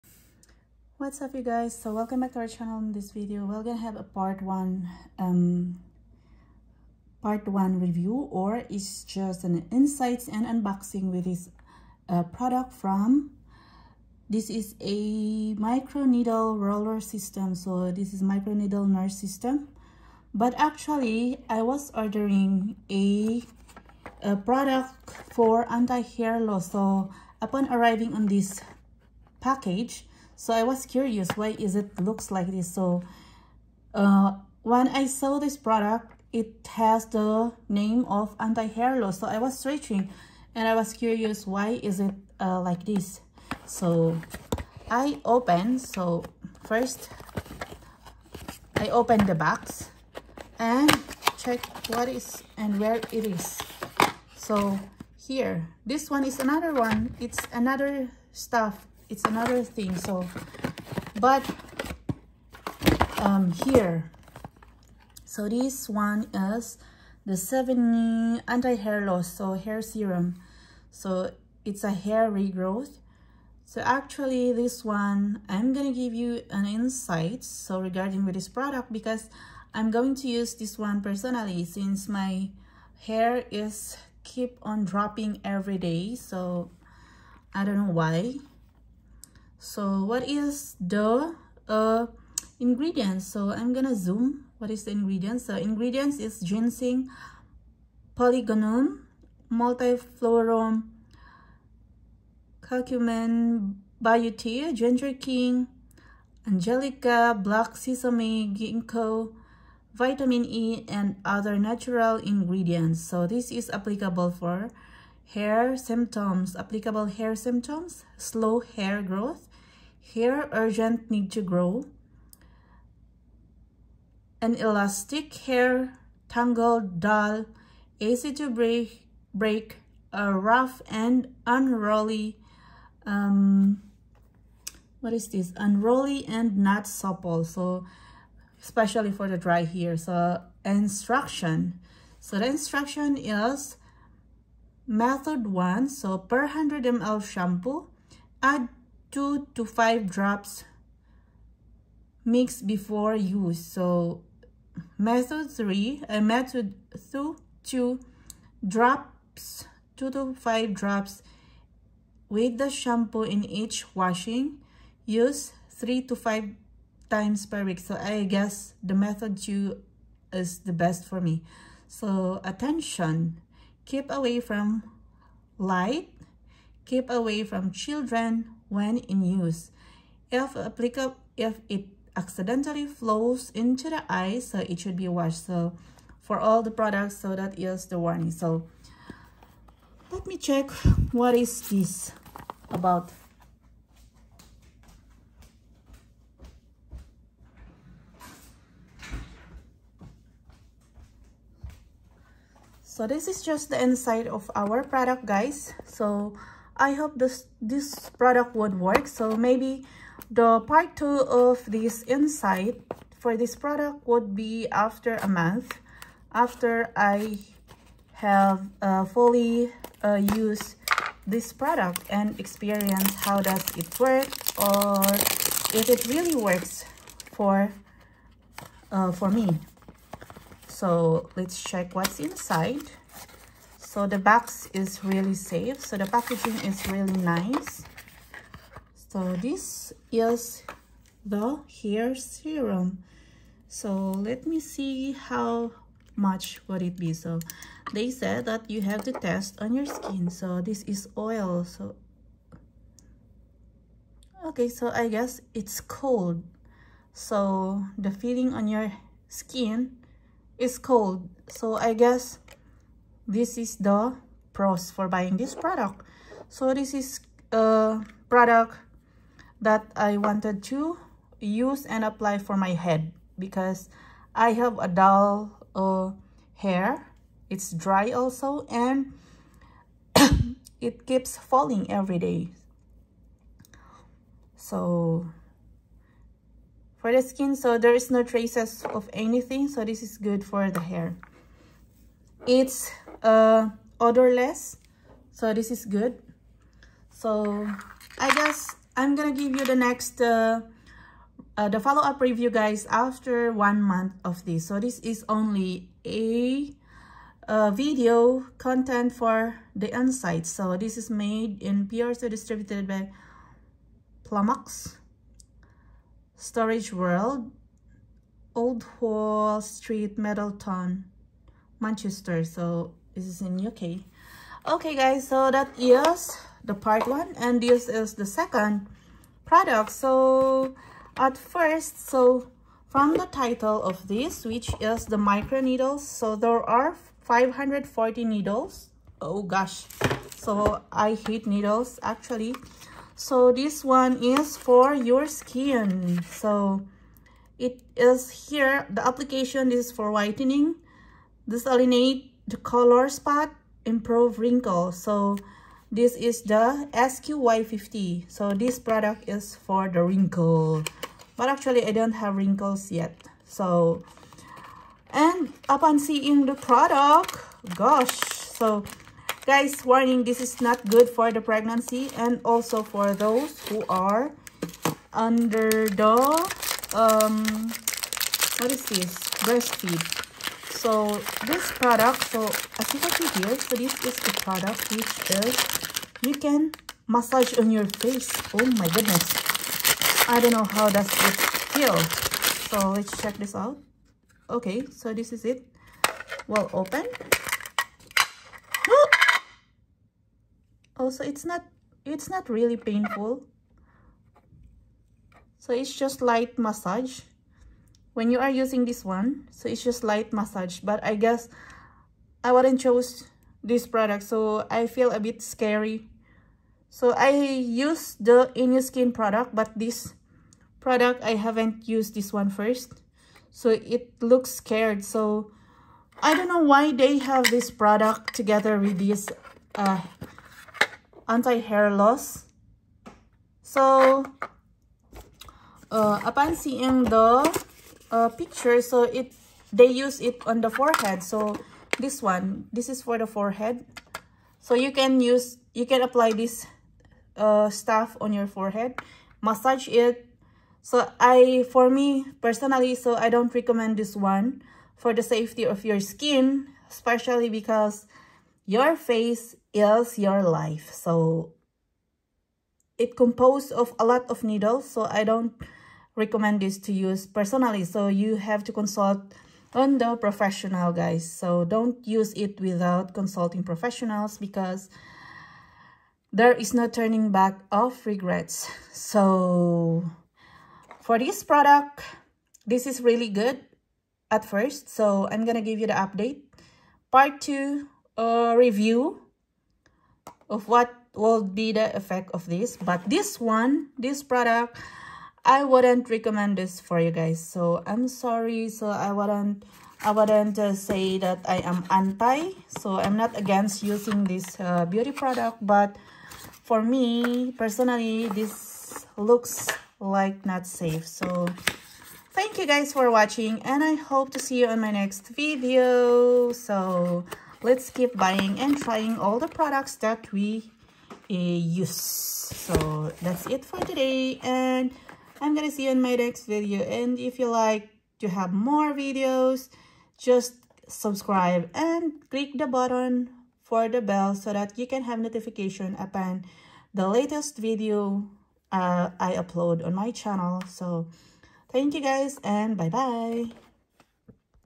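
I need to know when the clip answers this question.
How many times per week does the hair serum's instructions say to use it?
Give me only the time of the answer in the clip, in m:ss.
2:45.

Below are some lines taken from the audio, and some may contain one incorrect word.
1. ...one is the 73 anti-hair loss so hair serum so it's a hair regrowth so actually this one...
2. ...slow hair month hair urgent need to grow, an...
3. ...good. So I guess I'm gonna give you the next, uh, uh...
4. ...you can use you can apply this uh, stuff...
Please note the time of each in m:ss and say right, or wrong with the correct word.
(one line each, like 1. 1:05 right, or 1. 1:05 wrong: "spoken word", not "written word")
1. 1:05 wrong: "70", not "73"
2. 1:58 wrong: "growth", not "month"
3. 4:55 right
4. 7:24 right.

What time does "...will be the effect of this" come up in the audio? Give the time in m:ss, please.
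8:11.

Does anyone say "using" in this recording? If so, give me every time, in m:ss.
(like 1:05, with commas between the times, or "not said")
6:48, 8:23.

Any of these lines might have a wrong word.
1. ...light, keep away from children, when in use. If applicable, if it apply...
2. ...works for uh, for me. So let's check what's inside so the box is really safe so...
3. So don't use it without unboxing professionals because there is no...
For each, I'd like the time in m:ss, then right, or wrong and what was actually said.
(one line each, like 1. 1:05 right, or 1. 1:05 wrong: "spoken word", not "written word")
1. 2:55 wrong: "accidentally", not "apply"
2. 3:46 right
3. 7:51 wrong: "consulting", not "unboxing".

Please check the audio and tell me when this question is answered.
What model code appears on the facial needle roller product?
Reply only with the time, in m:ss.
5:56.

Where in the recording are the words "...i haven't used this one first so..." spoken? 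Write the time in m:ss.
7:01.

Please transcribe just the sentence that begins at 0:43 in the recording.
So I open, so first I open the box and check what is and where it is.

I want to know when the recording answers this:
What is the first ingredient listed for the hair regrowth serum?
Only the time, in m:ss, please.
1:36.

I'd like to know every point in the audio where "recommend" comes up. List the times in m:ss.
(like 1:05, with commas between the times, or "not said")
7:33, 7:46, 8:16.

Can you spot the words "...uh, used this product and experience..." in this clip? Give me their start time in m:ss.
3:40.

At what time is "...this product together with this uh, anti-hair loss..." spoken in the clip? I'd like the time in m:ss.
7:07.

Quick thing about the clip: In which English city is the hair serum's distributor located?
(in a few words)
Manchester.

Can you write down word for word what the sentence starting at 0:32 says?
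So uh, when I saw this product, it has the name of anti-hair loss.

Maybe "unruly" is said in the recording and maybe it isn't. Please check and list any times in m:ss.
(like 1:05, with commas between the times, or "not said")
2:11, 2:15.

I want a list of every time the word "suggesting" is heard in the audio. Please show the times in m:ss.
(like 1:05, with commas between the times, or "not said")
not said.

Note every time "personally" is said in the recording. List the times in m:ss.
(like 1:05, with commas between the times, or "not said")
1:21, 7:32, 7:47, 8:27.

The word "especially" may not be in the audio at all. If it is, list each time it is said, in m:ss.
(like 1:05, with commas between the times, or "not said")
2:18, 7:36.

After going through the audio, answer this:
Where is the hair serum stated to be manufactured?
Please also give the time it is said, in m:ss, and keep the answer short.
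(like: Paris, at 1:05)
PRC, at 5:11.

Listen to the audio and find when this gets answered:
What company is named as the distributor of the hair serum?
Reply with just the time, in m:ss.
5:14.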